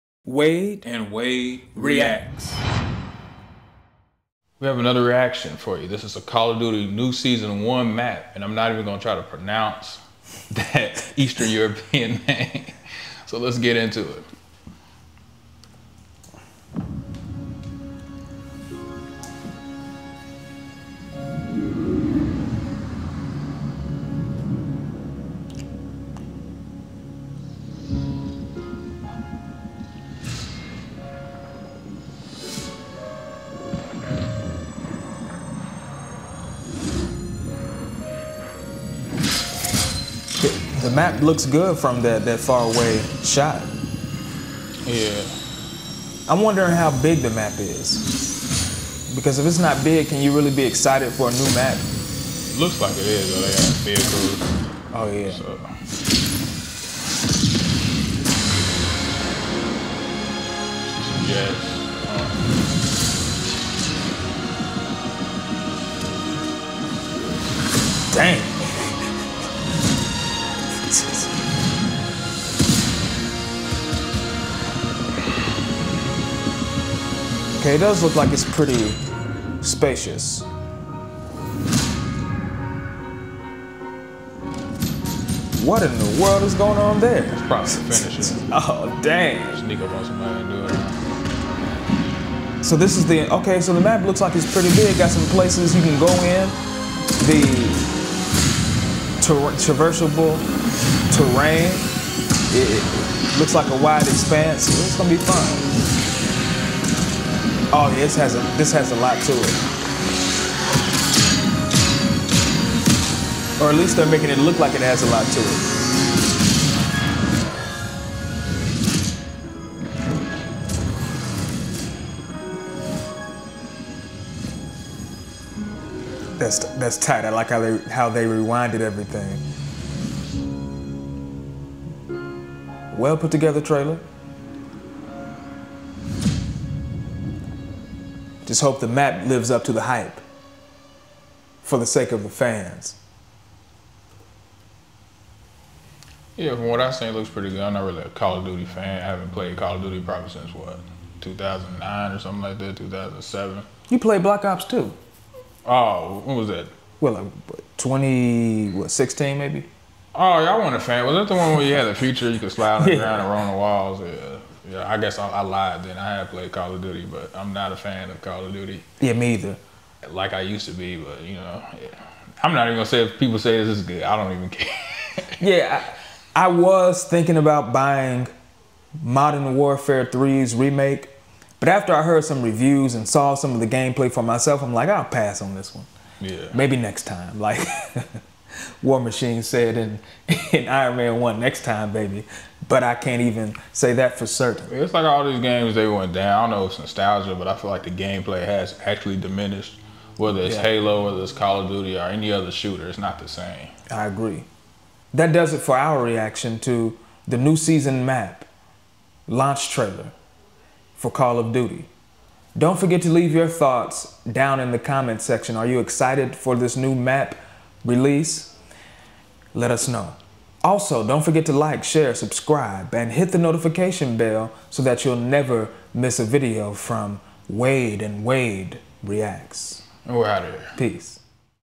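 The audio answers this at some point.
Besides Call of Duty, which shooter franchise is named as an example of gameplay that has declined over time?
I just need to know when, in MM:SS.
03:20.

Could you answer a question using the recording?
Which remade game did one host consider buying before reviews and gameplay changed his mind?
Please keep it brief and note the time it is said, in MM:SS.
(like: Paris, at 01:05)
Modern Warfare 3, at 02:59.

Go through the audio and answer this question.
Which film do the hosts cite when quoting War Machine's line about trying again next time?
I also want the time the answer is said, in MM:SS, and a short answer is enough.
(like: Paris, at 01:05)
Iron Man 1, at 03:10.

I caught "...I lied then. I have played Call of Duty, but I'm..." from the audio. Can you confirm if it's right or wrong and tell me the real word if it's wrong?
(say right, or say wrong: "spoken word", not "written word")
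right.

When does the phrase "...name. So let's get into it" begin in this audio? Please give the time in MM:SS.
00:12.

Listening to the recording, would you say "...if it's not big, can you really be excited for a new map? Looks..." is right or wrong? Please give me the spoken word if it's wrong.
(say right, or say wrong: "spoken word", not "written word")
right.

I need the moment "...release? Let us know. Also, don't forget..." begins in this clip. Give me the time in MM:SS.
03:37.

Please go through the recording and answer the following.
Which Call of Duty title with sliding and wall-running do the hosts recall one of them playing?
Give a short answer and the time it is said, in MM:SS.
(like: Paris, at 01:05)
Black Ops 2, at 02:34.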